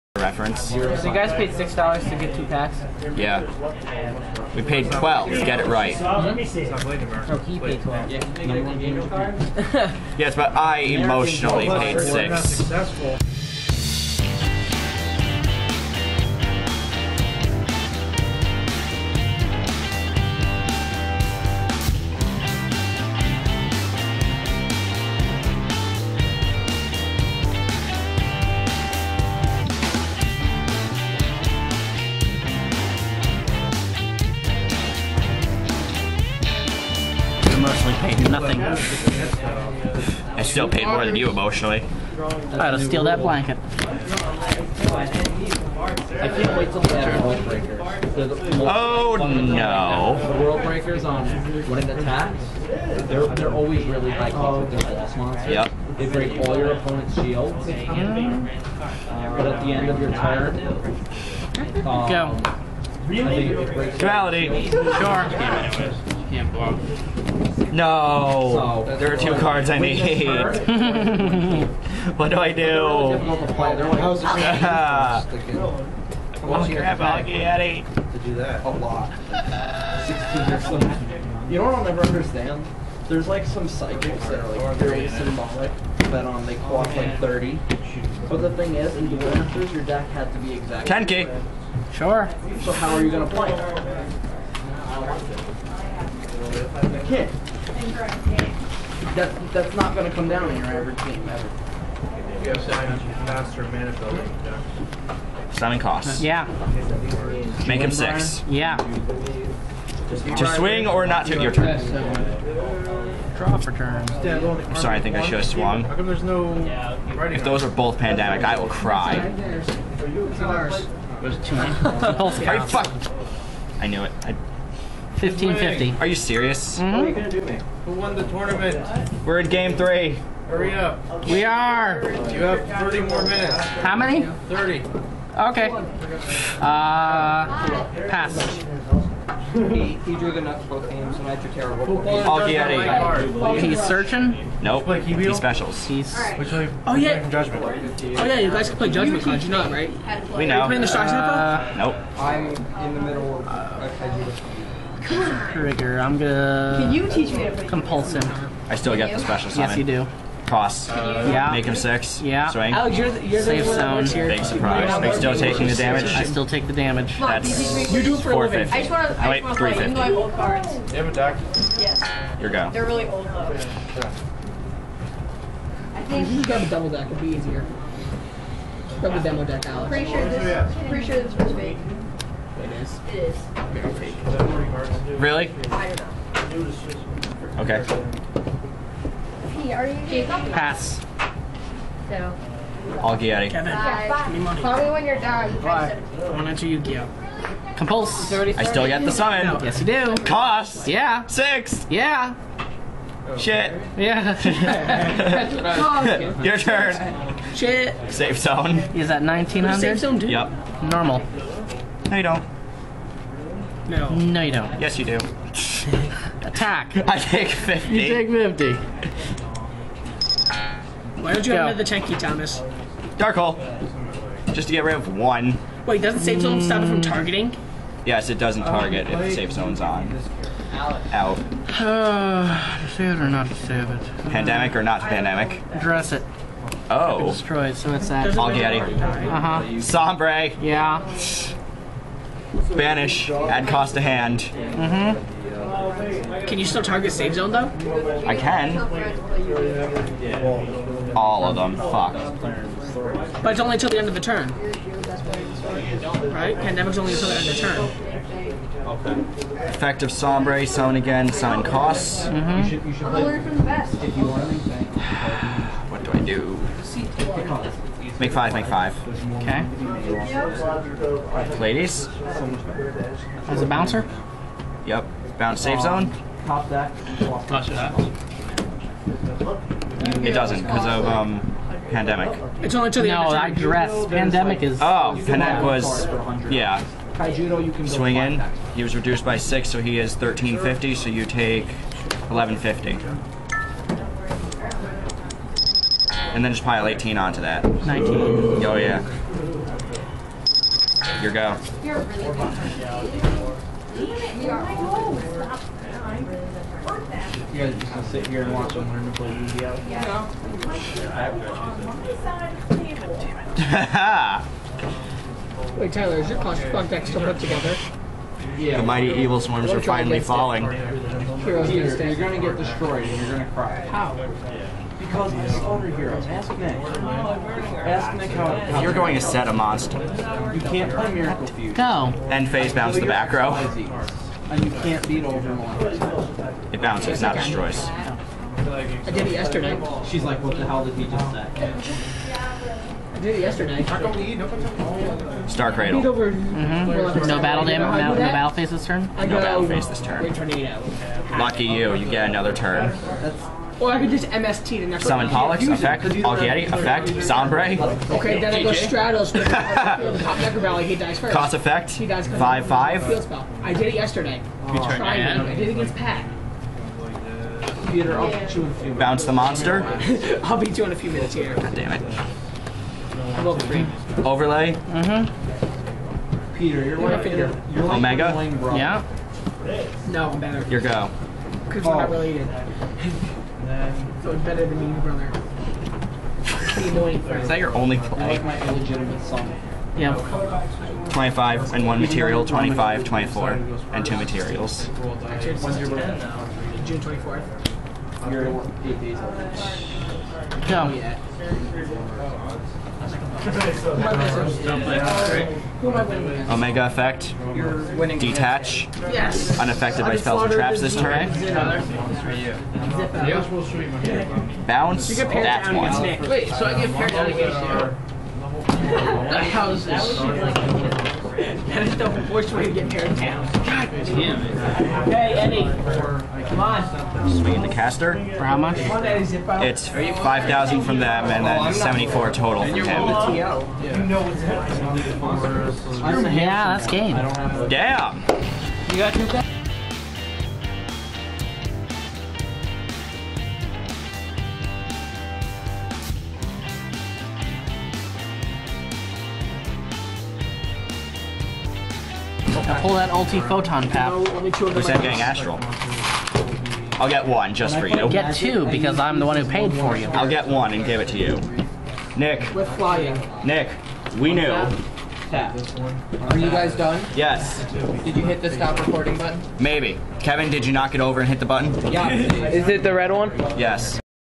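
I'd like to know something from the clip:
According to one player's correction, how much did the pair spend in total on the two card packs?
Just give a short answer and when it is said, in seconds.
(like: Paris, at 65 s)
12, at 4 s.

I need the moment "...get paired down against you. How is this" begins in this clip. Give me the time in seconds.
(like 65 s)
416 s.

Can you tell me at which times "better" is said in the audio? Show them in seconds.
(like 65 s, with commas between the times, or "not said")
380 s, 384 s.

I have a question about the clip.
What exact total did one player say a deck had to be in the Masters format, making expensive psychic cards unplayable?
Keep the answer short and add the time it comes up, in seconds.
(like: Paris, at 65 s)
10k, at 91 s.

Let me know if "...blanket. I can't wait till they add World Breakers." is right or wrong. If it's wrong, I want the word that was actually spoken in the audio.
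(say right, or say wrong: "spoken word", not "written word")
right.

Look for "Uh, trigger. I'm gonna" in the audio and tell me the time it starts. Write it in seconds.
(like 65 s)
153 s.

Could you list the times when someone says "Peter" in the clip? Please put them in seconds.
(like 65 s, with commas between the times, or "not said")
367 s, 376 s.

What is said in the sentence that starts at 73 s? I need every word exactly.
How's it crap, I'll get eight.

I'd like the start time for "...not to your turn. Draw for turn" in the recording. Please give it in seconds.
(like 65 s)
111 s.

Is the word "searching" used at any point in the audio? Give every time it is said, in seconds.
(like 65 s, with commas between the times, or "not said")
143 s.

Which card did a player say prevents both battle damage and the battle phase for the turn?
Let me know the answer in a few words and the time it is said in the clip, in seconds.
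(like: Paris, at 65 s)
Star Cradle, at 345 s.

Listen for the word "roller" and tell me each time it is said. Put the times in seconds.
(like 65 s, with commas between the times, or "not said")
not said.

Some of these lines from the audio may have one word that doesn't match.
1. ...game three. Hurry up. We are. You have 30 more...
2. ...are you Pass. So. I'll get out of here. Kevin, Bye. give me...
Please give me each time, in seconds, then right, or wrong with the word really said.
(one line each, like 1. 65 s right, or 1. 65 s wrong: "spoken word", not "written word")
1. 129 s right
2. 189 s right.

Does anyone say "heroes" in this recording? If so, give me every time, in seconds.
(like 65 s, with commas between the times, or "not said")
321 s, 325 s.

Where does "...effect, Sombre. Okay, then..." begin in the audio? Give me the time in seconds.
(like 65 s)
356 s.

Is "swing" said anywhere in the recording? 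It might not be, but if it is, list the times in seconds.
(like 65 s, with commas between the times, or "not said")
110 s, 162 s, 287 s.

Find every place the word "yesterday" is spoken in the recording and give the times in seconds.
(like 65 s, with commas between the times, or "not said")
339 s, 343 s, 363 s.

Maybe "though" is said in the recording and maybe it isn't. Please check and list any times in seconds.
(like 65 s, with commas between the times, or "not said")
173 s, 247 s.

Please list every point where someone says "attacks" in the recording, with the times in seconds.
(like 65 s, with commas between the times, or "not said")
51 s, 216 s.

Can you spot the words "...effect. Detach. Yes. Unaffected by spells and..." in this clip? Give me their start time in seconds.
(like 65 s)
406 s.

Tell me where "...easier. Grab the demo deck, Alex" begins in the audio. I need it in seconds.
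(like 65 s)
177 s.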